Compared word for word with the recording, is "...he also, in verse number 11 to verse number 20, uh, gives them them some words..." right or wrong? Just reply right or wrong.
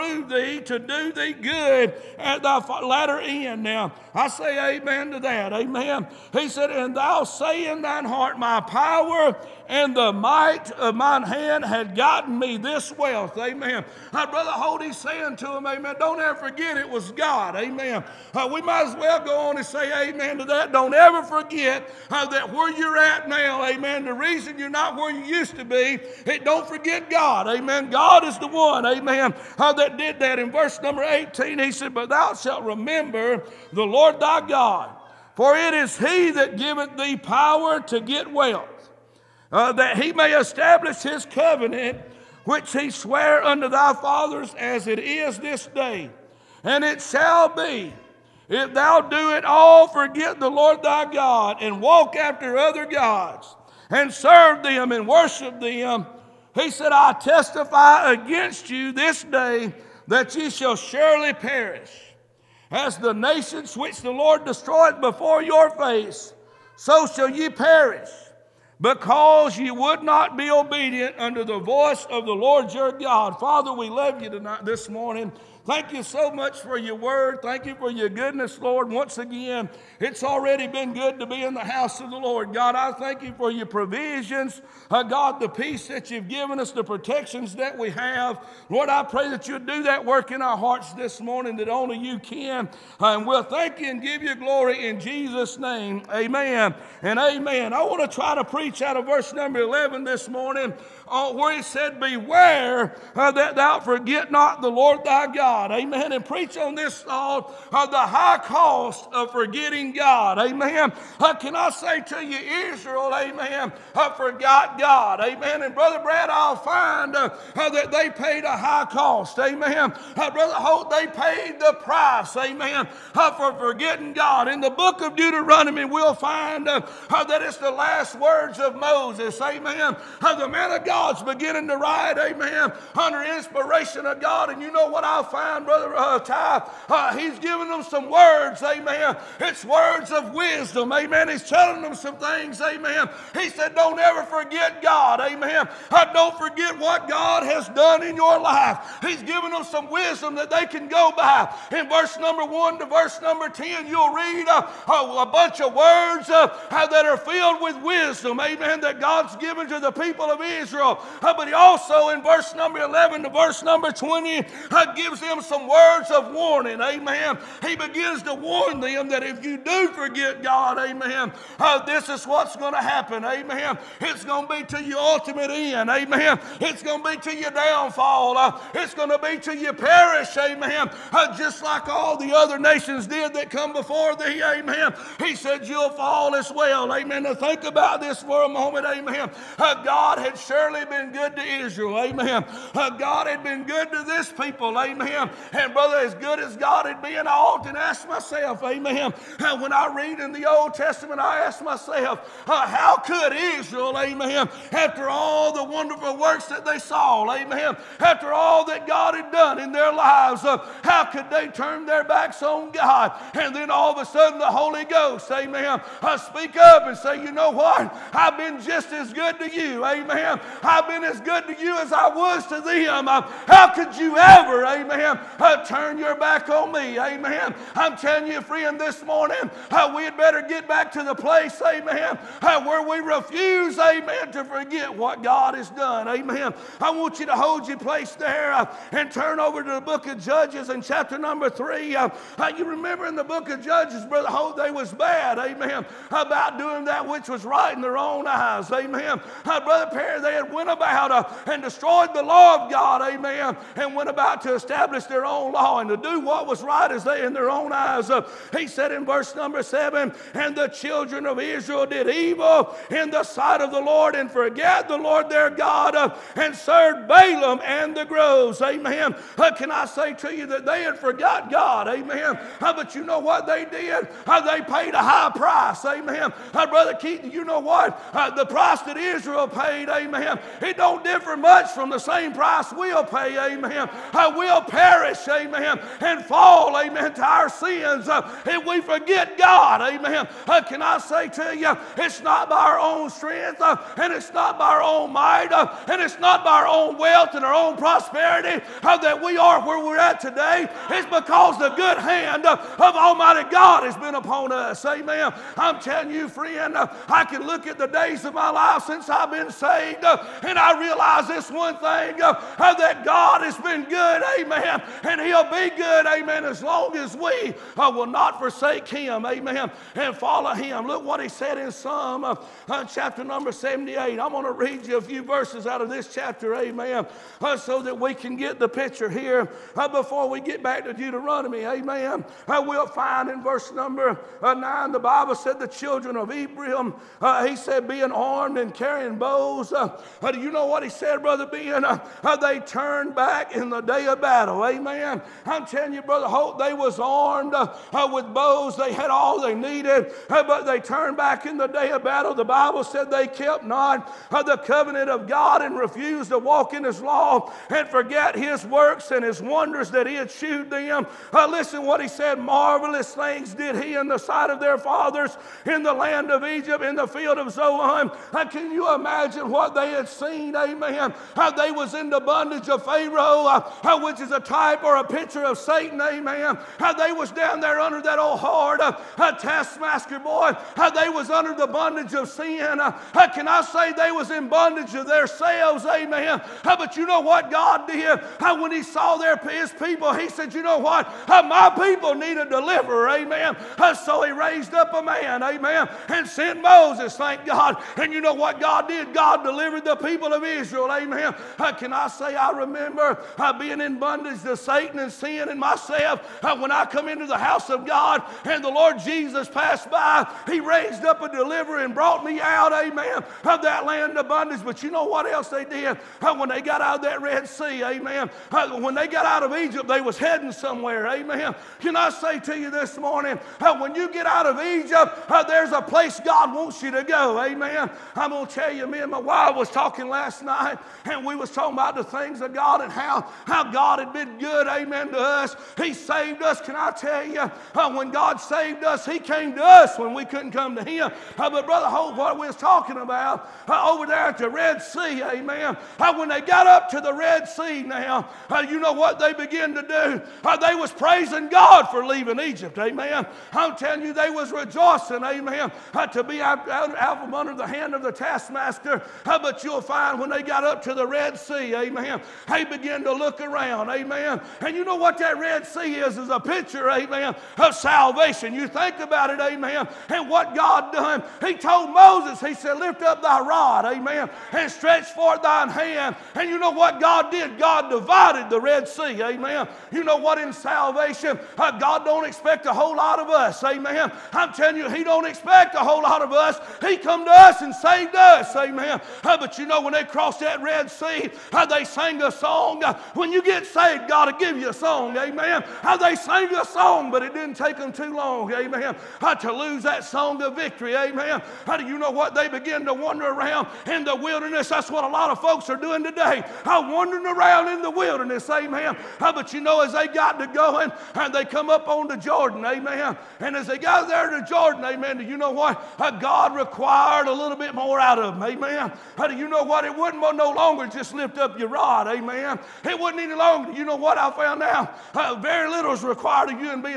right.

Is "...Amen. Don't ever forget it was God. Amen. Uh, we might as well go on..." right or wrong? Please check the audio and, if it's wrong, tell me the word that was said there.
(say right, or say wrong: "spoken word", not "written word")
right.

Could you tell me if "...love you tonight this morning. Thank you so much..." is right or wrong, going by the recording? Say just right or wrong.
right.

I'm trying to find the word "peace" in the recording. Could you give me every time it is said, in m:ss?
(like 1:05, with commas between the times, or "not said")
1:25.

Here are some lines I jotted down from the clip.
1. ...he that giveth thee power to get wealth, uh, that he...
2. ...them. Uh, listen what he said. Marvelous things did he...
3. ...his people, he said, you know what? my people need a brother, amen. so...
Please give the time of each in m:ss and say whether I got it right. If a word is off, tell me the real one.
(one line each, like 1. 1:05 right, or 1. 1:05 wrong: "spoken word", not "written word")
1. 0:35 right
2. 6:00 right
3. 6:29 wrong: "deliverer", not "brother".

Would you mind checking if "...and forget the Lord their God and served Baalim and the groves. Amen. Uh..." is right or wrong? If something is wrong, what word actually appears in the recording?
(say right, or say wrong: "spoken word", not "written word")
right.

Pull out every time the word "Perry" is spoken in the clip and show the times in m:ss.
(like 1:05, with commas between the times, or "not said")
4:09.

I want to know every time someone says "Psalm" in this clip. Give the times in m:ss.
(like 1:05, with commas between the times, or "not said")
5:21.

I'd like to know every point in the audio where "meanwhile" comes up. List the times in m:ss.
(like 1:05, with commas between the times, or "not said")
not said.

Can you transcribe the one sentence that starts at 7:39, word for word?
but you'll find when they got up to the Red Sea, amen, they began to look around, amen amen.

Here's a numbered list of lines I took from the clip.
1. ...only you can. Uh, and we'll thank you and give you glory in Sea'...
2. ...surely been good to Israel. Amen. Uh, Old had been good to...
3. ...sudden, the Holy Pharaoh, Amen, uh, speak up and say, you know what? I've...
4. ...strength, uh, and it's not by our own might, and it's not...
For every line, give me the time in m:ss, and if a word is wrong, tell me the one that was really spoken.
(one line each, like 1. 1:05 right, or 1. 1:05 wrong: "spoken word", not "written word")
1. 1:31 wrong: "Jesus", not "Sea"
2. 3:10 wrong: "God", not "Old"
3. 3:34 wrong: "Ghost", not "Pharaoh"
4. 4:53 right.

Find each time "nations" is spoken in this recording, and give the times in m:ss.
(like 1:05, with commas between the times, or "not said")
1:03, 3:02.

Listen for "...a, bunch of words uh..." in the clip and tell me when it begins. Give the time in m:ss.
2:35.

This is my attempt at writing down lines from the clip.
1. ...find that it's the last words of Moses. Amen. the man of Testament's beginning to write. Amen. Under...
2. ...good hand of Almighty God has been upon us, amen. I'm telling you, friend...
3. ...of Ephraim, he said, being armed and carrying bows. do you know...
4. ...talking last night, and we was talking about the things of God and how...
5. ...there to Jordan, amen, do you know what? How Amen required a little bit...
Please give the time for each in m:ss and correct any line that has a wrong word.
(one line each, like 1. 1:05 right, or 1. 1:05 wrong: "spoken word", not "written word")
1. 2:06 wrong: "God", not "Testament"
2. 5:01 right
3. 5:36 right
4. 7:09 right
5. 8:34 wrong: "God", not "Amen".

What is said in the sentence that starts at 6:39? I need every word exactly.
God delivered the people of Israel, amen.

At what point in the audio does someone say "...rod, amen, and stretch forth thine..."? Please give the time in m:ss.
7:53.